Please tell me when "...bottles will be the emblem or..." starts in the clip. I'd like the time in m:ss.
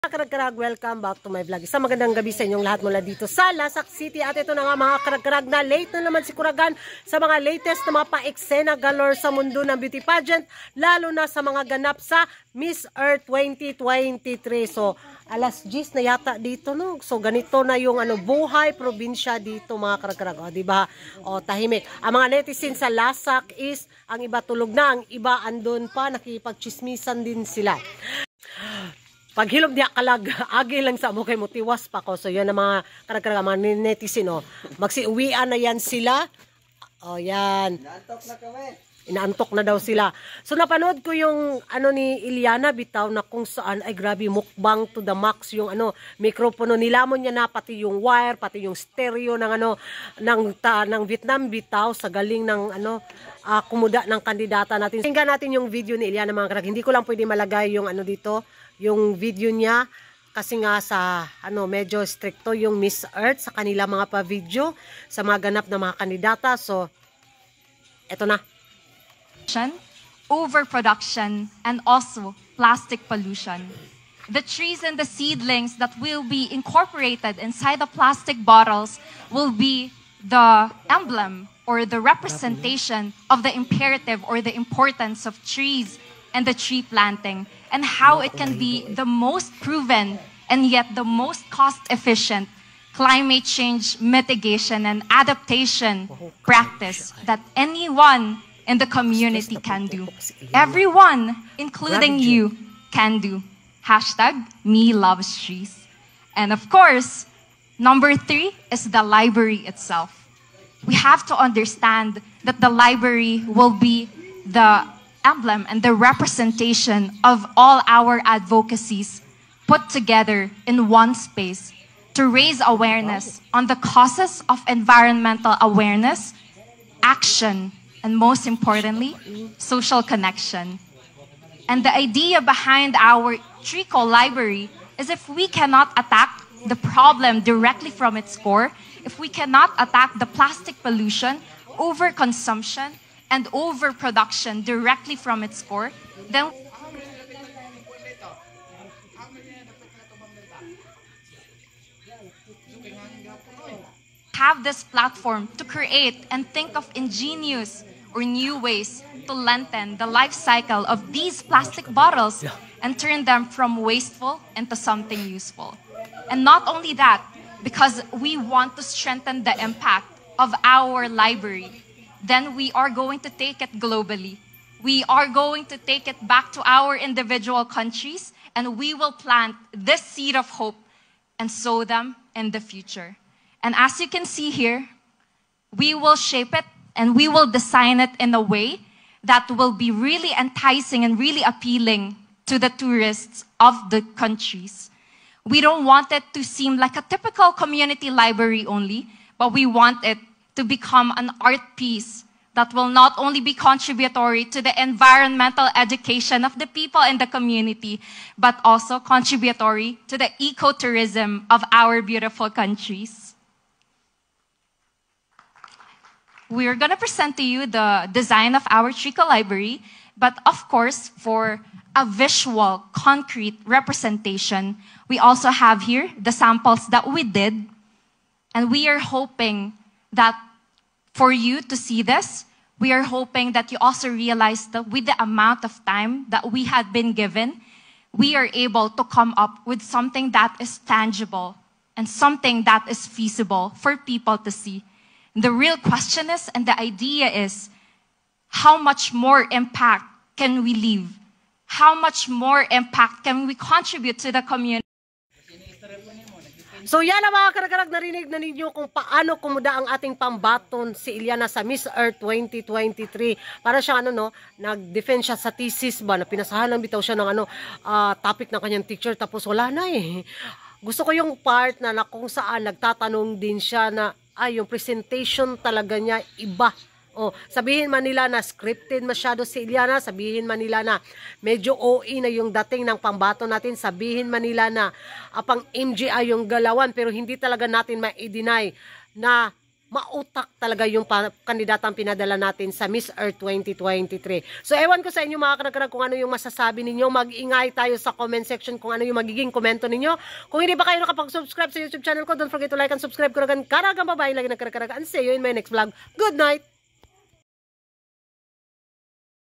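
1:18.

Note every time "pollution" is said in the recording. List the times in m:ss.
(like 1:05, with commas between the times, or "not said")
1:13, 2:20.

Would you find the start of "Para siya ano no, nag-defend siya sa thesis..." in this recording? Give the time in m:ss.
4:23.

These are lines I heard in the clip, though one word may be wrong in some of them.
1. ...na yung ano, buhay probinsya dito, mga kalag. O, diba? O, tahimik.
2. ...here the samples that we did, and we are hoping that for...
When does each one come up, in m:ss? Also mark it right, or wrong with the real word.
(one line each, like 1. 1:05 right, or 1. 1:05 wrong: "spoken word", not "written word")
1. 0:17 wrong: "karakarag", not "kalag"
2. 3:45 right.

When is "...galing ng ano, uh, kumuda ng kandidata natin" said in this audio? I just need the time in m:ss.
0:52.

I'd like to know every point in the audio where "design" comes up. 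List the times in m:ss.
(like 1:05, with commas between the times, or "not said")
3:07, 3:38.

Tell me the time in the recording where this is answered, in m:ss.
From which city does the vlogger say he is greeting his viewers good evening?
0:03.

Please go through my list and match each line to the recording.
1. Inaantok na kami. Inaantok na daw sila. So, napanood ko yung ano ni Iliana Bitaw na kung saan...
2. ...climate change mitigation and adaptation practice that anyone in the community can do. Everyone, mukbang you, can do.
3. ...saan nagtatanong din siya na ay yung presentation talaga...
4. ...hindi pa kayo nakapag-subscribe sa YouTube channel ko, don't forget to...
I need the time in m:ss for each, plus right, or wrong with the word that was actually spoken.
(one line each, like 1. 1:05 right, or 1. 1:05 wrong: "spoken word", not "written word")
1. 0:37 right
2. 1:32 wrong: "including", not "mukbang"
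3. 4:32 right
4. 5:00 right.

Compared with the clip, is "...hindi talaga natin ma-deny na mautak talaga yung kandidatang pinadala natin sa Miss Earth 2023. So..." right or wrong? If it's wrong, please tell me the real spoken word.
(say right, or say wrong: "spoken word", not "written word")
right.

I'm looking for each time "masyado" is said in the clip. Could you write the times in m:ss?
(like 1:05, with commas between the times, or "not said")
4:39.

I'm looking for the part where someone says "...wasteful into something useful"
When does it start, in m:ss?
2:43.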